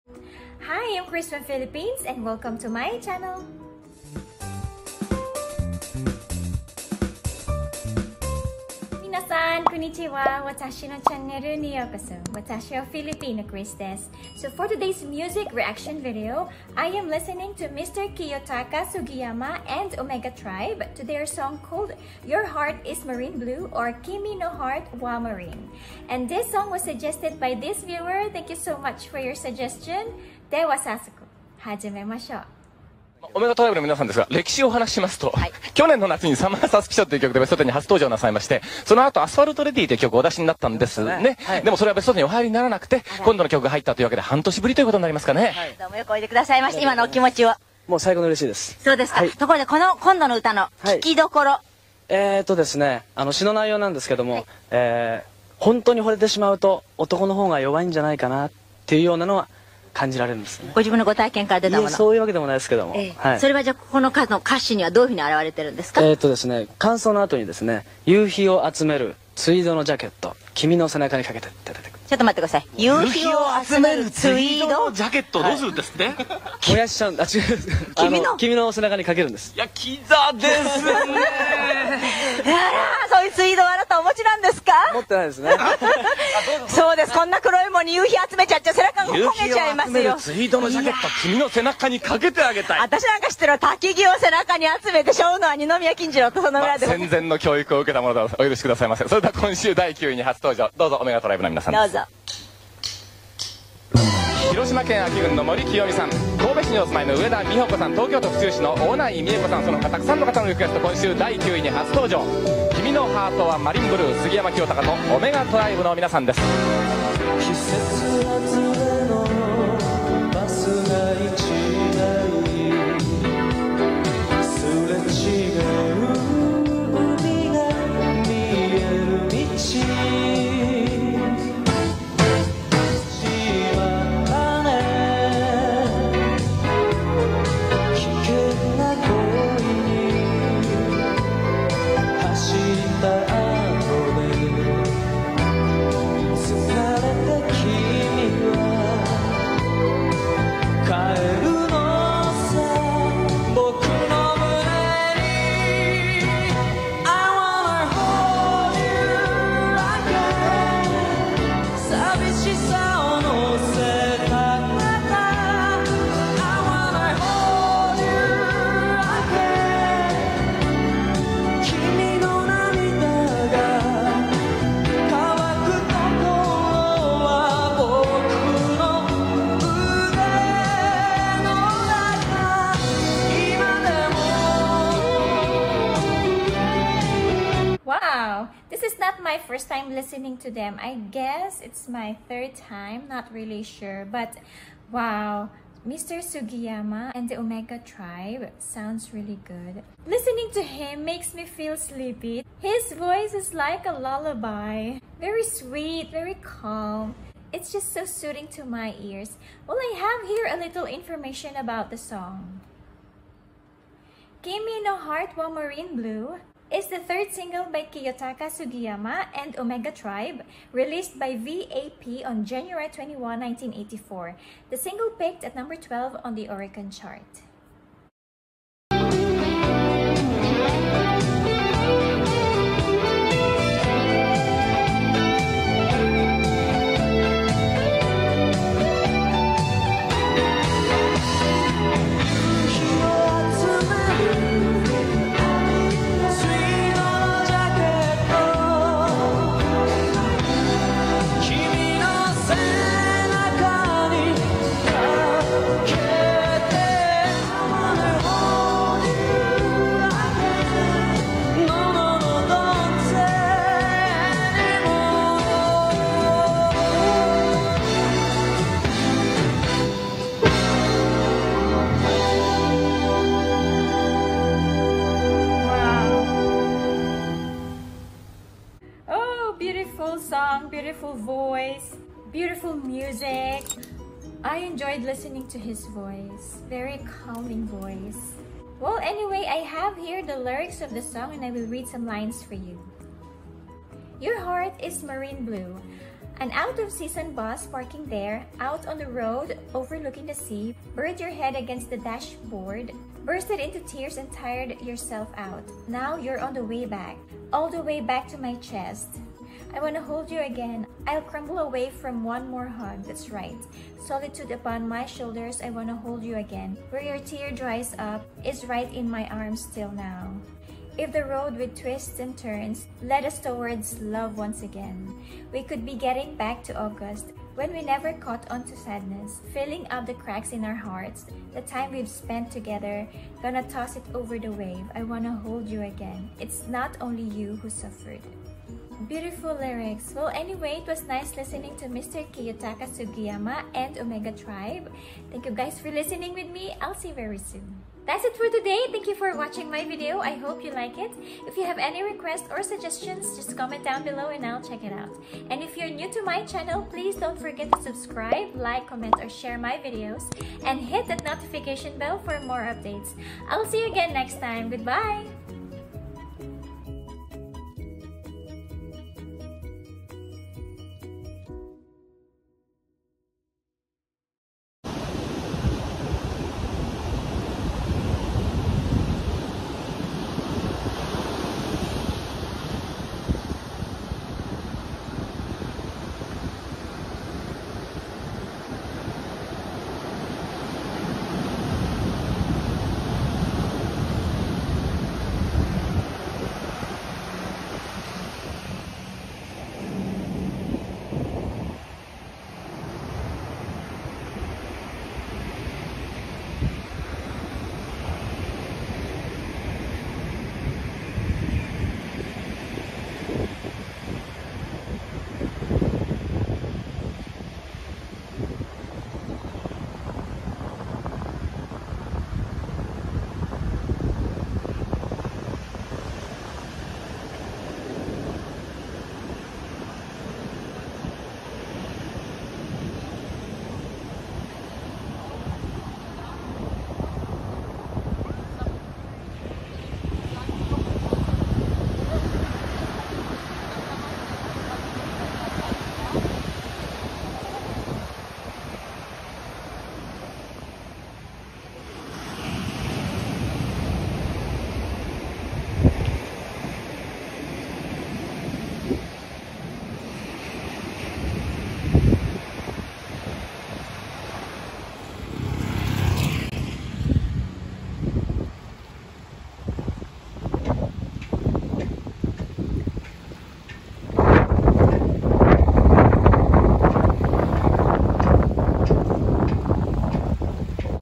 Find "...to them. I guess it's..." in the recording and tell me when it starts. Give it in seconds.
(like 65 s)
190 s.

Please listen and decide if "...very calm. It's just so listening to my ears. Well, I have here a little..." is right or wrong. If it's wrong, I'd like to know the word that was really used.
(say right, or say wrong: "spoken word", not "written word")
wrong: "soothing", not "listening".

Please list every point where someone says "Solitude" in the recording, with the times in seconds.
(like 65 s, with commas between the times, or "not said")
314 s.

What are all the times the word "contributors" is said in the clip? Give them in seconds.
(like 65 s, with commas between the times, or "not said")
not said.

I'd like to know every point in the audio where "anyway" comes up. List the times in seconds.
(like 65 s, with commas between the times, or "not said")
289 s, 340 s.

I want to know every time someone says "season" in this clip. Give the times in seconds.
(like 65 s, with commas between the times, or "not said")
296 s.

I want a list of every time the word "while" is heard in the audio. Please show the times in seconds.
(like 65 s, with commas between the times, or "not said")
215 s.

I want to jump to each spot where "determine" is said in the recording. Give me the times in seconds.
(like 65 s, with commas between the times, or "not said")
not said.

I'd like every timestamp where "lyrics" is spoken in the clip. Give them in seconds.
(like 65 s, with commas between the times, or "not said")
290 s, 339 s.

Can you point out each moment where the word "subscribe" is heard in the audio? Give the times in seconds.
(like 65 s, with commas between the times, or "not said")
357 s.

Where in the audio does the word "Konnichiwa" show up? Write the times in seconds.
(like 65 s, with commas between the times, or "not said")
9 s.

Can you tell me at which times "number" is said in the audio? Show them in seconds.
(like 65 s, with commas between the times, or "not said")
225 s.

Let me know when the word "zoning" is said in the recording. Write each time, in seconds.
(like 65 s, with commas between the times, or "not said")
not said.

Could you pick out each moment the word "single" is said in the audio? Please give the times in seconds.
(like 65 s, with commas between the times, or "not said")
217 s, 224 s.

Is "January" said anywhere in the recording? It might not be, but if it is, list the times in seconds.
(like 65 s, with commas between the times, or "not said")
222 s.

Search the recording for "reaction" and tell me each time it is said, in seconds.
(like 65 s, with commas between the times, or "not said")
15 s.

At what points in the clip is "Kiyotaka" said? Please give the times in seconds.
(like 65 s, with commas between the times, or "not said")
18 s, 217 s, 342 s.